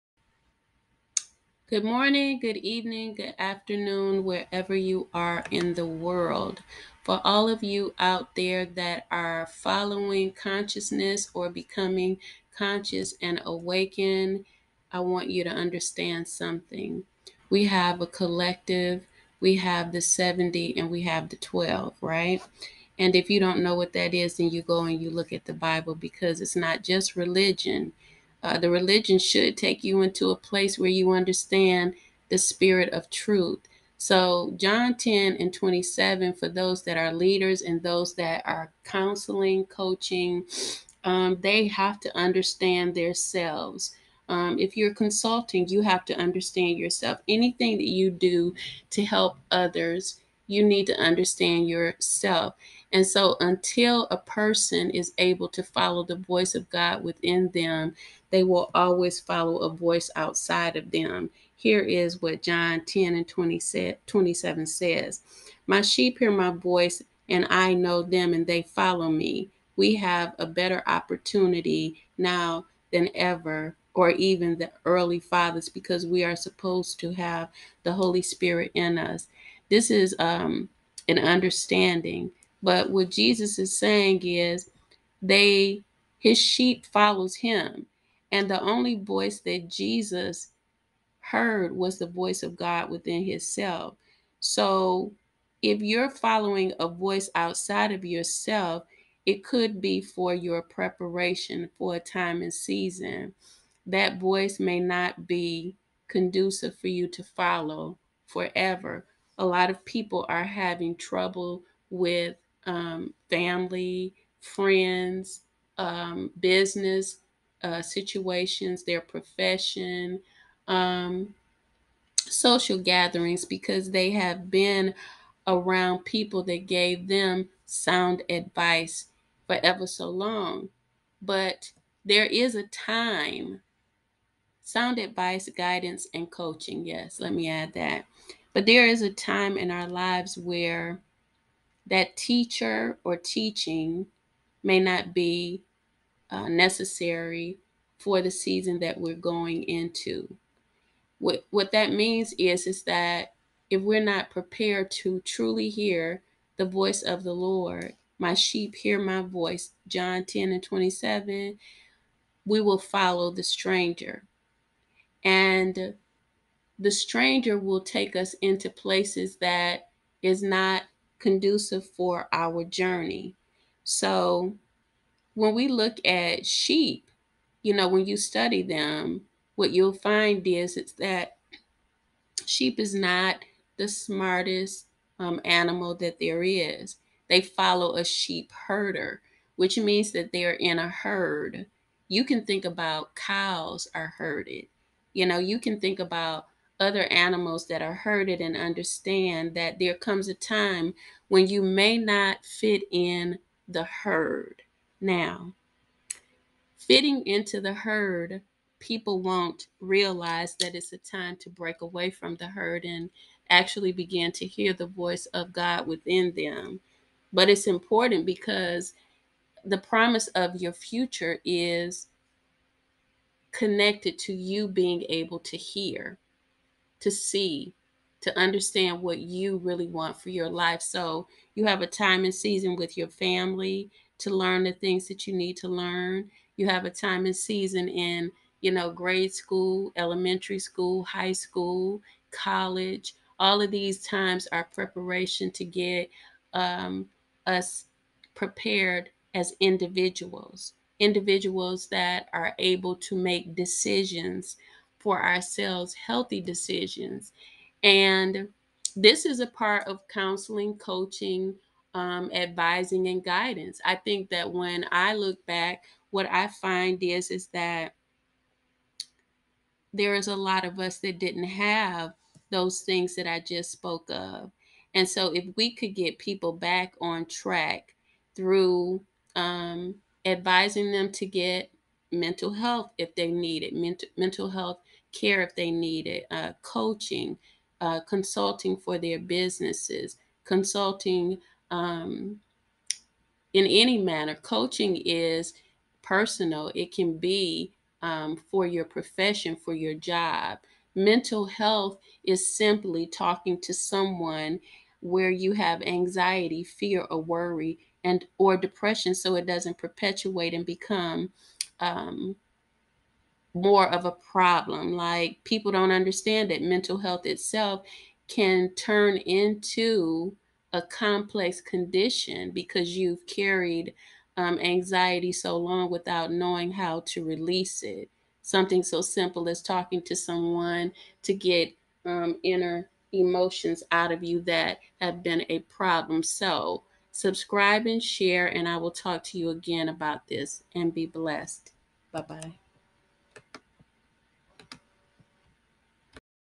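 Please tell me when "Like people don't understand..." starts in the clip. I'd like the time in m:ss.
5:14.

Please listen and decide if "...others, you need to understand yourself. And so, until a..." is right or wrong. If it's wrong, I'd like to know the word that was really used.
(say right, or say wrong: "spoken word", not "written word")
right.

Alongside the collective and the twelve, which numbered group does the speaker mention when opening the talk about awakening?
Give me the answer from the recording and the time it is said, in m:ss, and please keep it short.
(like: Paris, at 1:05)
70, at 0:20.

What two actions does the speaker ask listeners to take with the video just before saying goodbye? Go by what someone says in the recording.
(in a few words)
Subscribe and share.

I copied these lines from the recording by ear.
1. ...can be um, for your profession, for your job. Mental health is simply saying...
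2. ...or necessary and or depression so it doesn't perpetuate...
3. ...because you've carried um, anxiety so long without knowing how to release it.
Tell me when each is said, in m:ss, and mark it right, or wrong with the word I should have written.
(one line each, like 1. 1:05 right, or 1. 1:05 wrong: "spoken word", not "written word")
1. 4:56 wrong: "talking", not "saying"
2. 5:07 wrong: "worry", not "necessary"
3. 5:22 right.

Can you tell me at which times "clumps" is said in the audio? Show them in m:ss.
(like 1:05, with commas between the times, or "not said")
not said.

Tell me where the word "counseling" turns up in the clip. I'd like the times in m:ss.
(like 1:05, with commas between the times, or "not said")
0:38, 4:20.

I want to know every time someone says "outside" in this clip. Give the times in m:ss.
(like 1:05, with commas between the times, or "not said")
1:00, 1:37.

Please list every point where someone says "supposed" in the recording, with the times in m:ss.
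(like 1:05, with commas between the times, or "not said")
1:16.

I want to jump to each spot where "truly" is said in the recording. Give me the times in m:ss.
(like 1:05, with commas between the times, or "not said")
2:35.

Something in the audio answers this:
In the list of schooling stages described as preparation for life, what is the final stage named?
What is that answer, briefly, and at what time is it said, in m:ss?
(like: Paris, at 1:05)
college, at 4:02.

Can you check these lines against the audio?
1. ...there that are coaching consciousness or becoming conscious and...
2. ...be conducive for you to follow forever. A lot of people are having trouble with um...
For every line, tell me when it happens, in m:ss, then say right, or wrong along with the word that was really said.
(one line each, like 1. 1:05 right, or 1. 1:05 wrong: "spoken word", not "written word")
1. 0:08 wrong: "following", not "coaching"
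2. 1:45 right.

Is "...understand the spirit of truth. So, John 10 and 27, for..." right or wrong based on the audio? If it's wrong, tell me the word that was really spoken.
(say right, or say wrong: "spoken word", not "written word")
right.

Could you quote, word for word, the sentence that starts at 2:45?
And the stranger will take us into places that is not conducive for our journey.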